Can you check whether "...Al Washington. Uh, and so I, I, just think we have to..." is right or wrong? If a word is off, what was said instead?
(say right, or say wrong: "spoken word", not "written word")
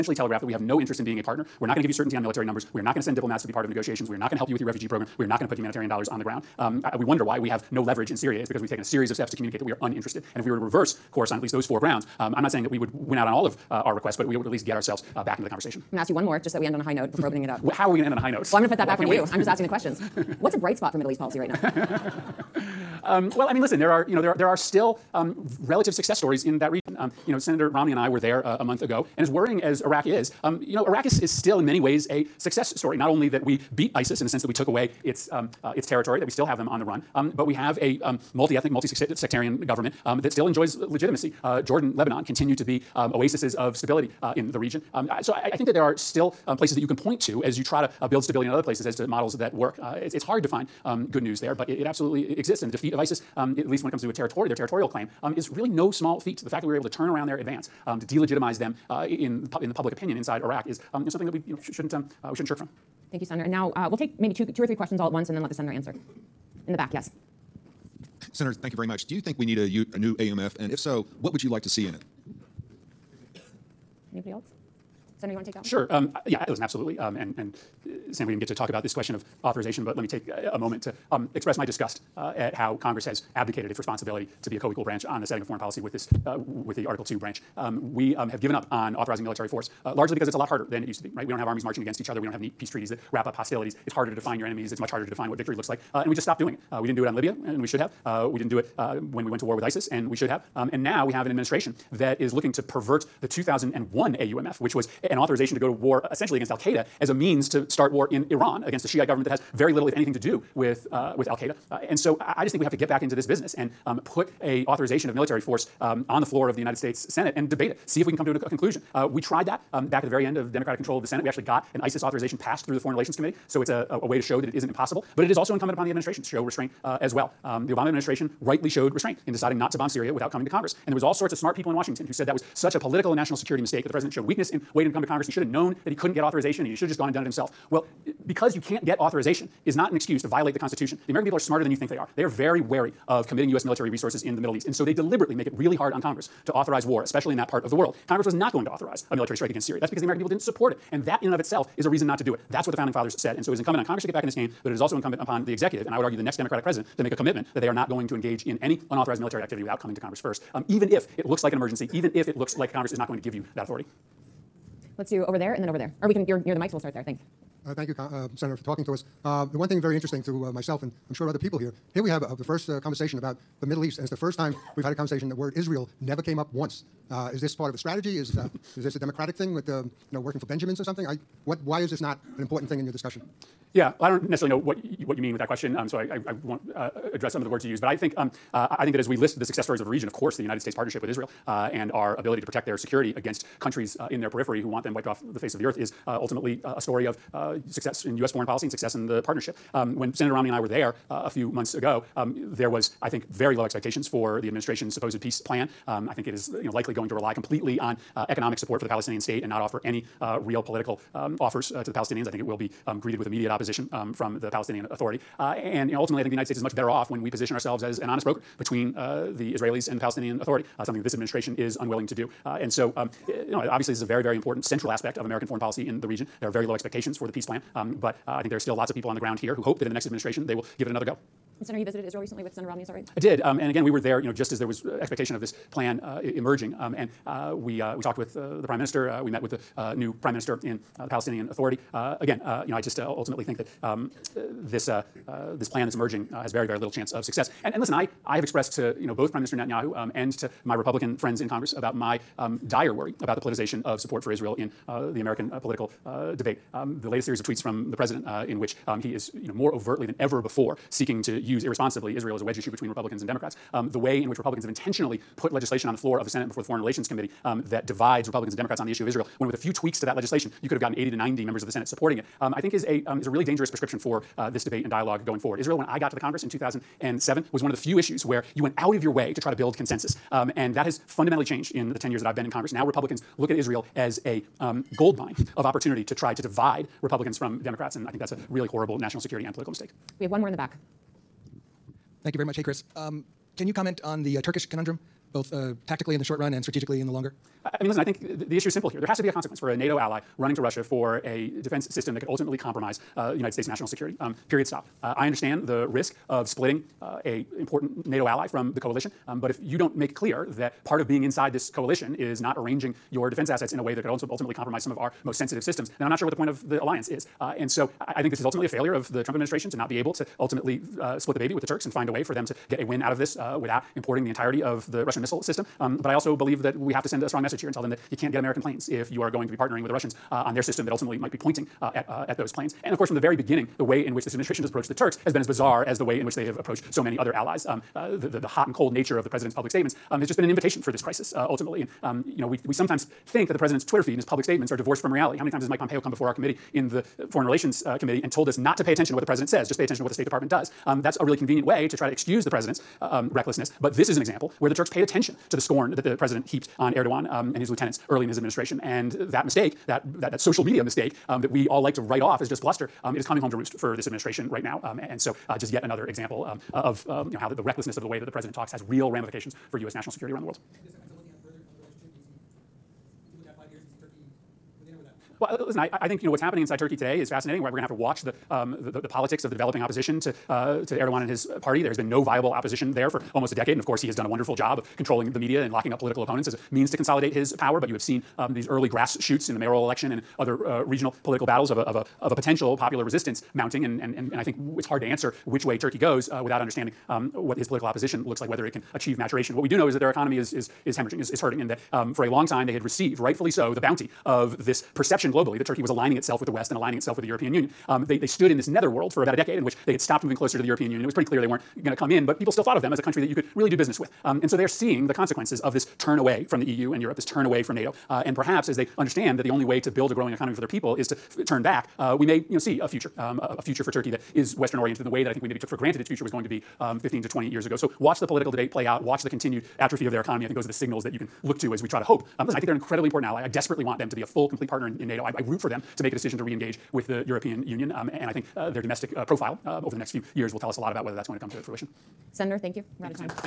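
wrong: "Qaeda", not "Washington".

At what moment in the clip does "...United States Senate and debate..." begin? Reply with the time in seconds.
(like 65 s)
116 s.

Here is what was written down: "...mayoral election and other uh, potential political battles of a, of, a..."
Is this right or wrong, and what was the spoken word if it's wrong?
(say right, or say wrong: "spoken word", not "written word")
wrong: "regional", not "potential".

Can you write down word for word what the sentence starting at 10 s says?
And if we were to reverse reverse course on at least those four grounds.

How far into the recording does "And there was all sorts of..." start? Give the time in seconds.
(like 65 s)
130 s.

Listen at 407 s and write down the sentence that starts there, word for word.
Um, they, they stood in this netherworld for about a decade in which they had stopped moving closer to the European Union.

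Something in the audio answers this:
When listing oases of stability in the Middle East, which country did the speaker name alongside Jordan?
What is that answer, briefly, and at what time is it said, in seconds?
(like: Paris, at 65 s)
Lebanon, at 41 s.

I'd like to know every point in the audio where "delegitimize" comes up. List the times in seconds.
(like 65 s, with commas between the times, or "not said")
58 s.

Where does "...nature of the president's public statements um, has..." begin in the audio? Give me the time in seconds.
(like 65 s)
338 s.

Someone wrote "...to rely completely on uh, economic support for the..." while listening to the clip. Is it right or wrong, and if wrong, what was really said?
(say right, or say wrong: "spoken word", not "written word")
right.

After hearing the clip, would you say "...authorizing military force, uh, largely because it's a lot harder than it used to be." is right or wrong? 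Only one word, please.
right.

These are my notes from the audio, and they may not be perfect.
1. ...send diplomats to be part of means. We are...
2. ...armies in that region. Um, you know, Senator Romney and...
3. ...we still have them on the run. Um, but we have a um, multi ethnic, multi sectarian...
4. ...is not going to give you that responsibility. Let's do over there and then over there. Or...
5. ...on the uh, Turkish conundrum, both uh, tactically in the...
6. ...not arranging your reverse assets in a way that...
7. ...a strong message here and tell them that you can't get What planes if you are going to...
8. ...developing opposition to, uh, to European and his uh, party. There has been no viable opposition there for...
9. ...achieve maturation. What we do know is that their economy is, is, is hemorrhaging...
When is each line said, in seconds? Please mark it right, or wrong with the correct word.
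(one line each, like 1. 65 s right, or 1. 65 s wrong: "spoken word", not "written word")
1. 3 s wrong: "negotiations", not "means"
2. 26 s wrong: "stories", not "armies"
3. 36 s right
4. 162 s wrong: "authority", not "responsibility"
5. 294 s right
6. 312 s wrong: "defense", not "reverse"
7. 327 s wrong: "American", not "What"
8. 379 s wrong: "Erdogan", not "European"
9. 398 s right.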